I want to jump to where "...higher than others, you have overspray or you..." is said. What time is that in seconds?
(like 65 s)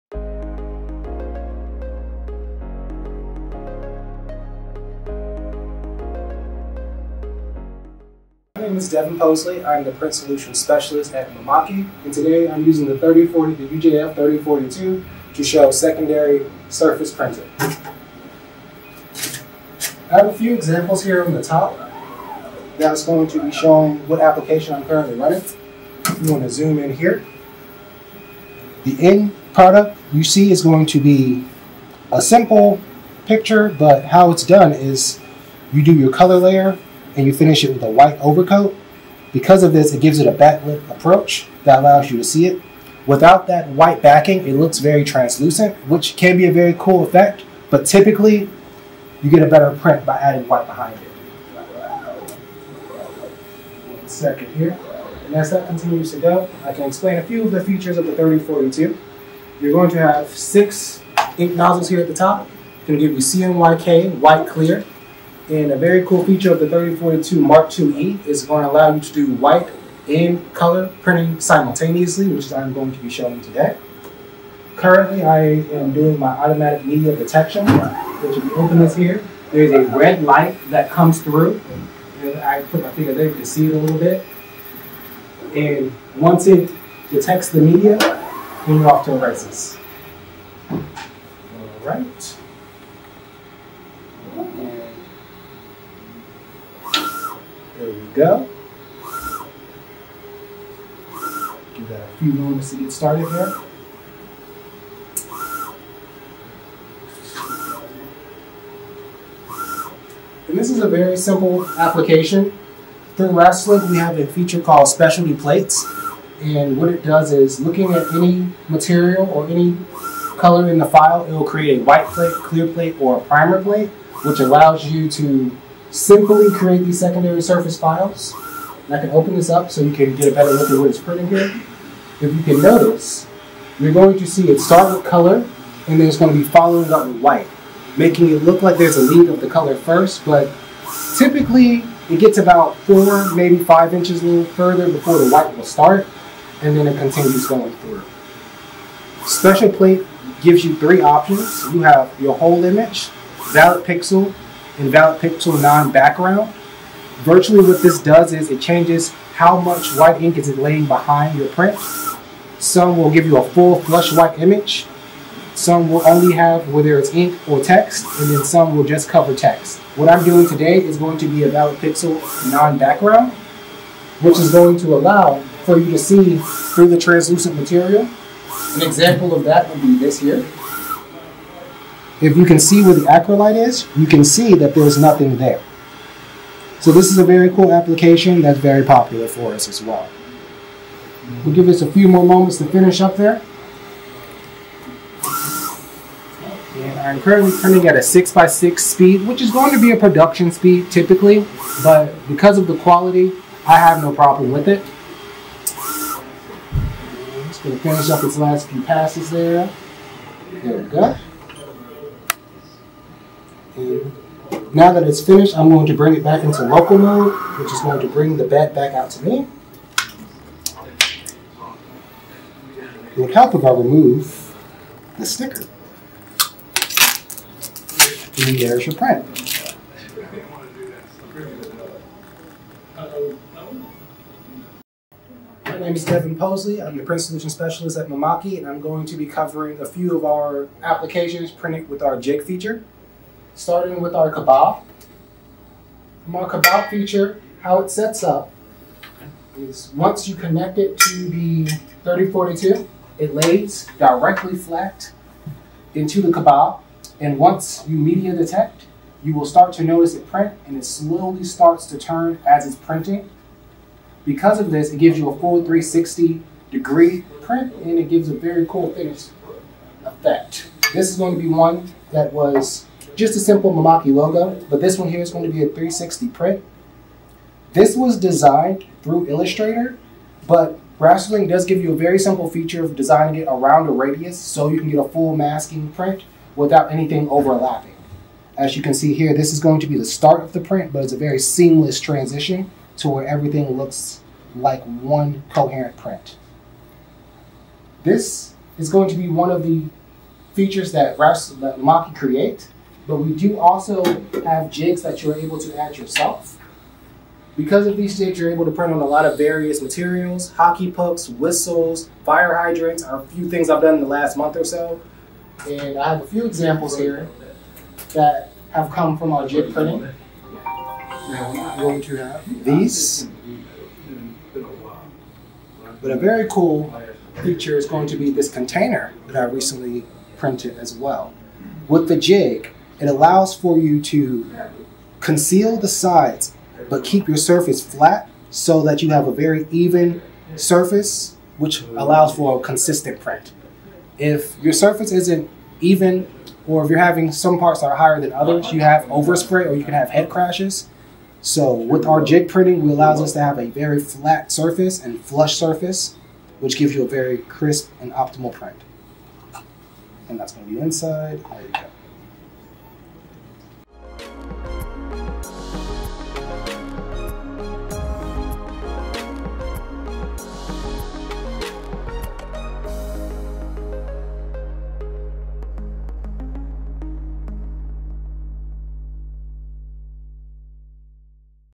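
347 s.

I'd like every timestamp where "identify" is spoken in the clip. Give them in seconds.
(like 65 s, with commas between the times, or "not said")
not said.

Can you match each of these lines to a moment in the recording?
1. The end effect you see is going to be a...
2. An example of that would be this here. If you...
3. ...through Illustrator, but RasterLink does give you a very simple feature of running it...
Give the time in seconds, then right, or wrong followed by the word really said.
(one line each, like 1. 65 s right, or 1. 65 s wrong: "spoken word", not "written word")
1. 28 s wrong: "product", not "effect"
2. 178 s right
3. 279 s wrong: "designing", not "running".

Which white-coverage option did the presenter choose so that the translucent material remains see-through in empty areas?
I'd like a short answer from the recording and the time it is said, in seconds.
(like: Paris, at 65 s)
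valid pixel non-background, at 171 s.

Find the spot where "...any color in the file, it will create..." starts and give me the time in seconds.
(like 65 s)
119 s.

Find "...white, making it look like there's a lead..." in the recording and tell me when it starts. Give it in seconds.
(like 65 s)
137 s.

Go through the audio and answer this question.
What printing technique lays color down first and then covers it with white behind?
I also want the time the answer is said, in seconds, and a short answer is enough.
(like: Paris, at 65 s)
secondary surface printing, at 15 s.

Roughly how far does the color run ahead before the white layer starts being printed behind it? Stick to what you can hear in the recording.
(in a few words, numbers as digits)
4 or 5 inches.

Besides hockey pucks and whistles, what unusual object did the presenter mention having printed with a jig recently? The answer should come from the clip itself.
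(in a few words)
fire hydrants.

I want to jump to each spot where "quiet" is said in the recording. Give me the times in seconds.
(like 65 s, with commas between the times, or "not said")
not said.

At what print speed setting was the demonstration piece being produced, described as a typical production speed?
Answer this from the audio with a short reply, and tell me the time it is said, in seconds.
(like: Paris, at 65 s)
6x6, at 198 s.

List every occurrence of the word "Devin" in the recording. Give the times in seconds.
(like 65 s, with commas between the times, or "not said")
8 s, 236 s.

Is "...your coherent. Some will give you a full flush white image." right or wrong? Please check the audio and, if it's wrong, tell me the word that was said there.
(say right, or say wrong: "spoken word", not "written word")
wrong: "print", not "coherent".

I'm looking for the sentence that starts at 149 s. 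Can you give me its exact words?
Special plate gives you three options.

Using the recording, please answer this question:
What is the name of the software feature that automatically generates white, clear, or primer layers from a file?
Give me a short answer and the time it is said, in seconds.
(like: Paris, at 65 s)
specialty plates, at 114 s.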